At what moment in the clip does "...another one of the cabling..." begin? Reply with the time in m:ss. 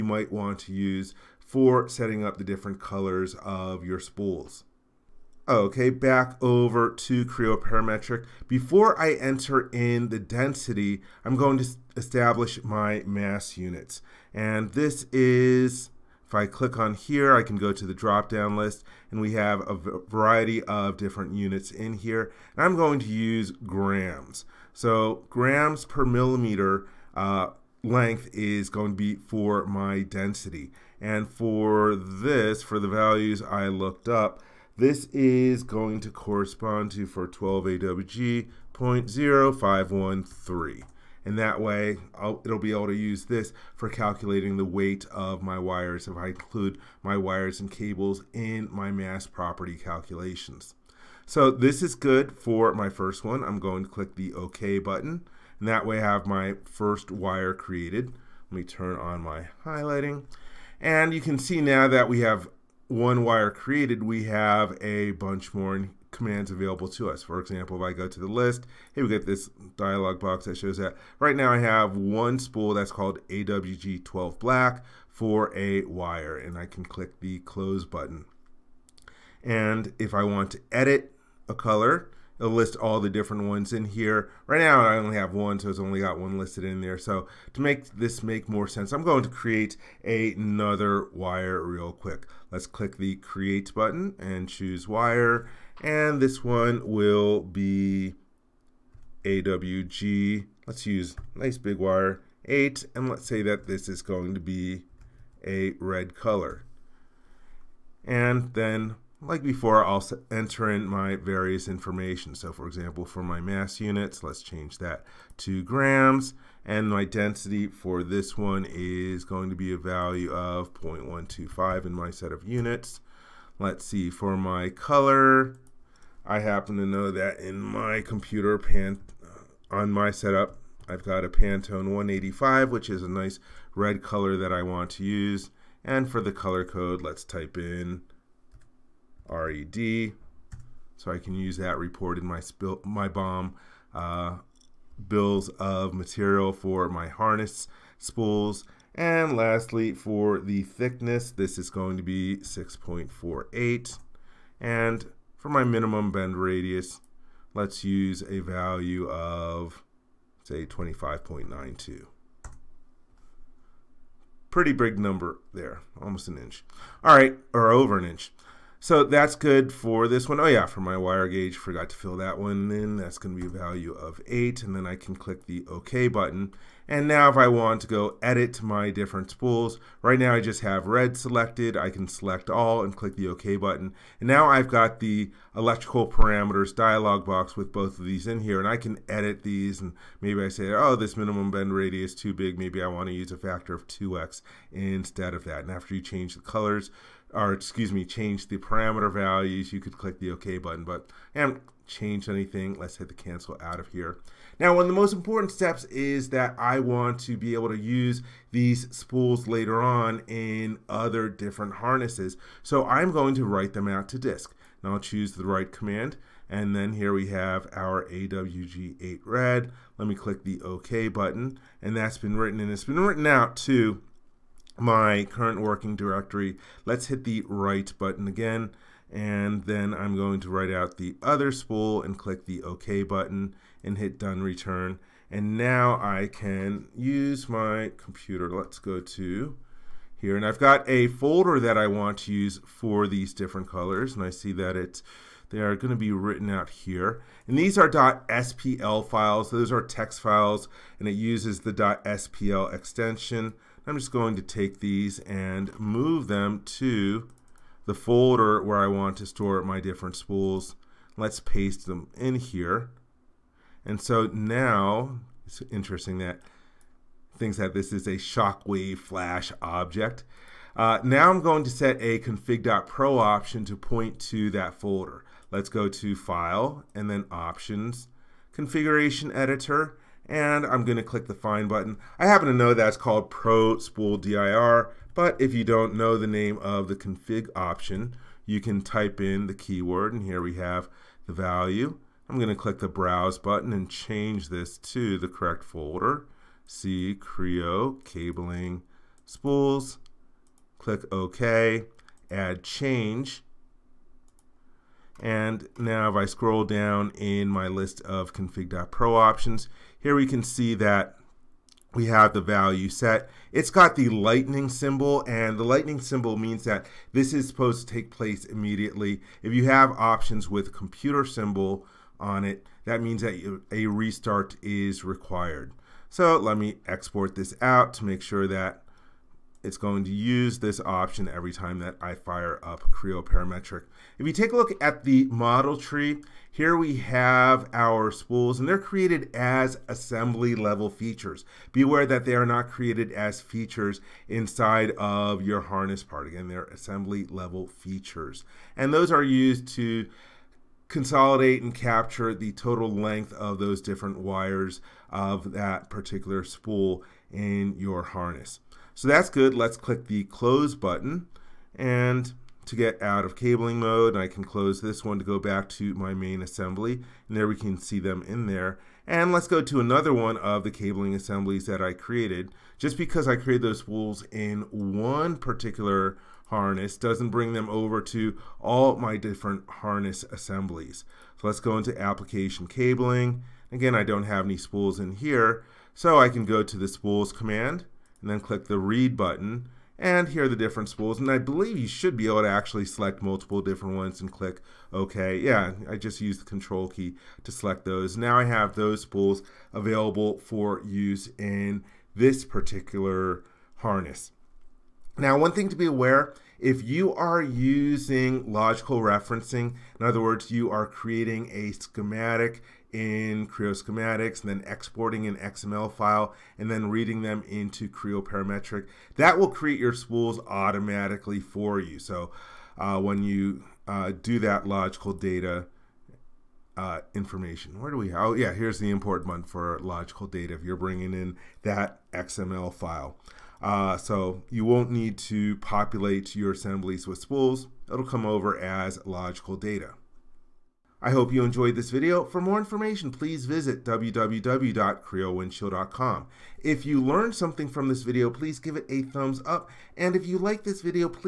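6:09.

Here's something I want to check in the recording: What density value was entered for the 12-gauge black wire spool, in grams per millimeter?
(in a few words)
0.0513.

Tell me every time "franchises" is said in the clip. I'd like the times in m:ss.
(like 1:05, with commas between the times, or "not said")
not said.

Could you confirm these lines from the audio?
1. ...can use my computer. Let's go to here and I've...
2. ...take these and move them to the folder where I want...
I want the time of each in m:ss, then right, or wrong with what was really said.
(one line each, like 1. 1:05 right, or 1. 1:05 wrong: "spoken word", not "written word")
1. 3:56 right
2. 4:14 right.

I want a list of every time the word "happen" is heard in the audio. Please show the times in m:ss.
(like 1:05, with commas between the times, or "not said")
2:06, 4:42.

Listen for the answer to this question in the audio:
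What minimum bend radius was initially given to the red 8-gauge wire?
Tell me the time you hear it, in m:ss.
2:40.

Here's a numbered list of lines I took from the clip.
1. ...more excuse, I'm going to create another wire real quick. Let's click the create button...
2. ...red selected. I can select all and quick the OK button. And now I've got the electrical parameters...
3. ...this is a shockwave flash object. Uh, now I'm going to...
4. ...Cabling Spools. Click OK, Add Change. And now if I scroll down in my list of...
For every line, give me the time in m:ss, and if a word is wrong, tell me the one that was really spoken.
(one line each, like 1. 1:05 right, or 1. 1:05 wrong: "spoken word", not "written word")
1. 1:28 wrong: "sense", not "excuse"
2. 3:00 wrong: "click", not "quick"
3. 4:27 right
4. 4:58 right.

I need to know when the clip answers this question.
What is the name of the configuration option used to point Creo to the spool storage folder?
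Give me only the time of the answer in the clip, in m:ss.
4:43.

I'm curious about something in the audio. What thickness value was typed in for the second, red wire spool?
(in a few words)
6.48.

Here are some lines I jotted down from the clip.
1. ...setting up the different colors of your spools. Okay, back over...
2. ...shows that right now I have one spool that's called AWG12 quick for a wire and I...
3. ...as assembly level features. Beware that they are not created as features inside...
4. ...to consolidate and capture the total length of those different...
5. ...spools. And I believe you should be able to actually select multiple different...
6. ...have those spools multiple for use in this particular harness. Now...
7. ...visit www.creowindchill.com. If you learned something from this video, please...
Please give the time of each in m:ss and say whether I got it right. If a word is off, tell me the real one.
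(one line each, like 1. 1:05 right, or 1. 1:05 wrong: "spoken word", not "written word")
1. 0:01 right
2. 1:10 wrong: "black", not "quick"
3. 5:39 right
4. 5:49 right
5. 6:30 right
6. 6:38 wrong: "available", not "multiple"
7. 7:23 right.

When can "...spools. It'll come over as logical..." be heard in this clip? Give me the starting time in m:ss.
7:17.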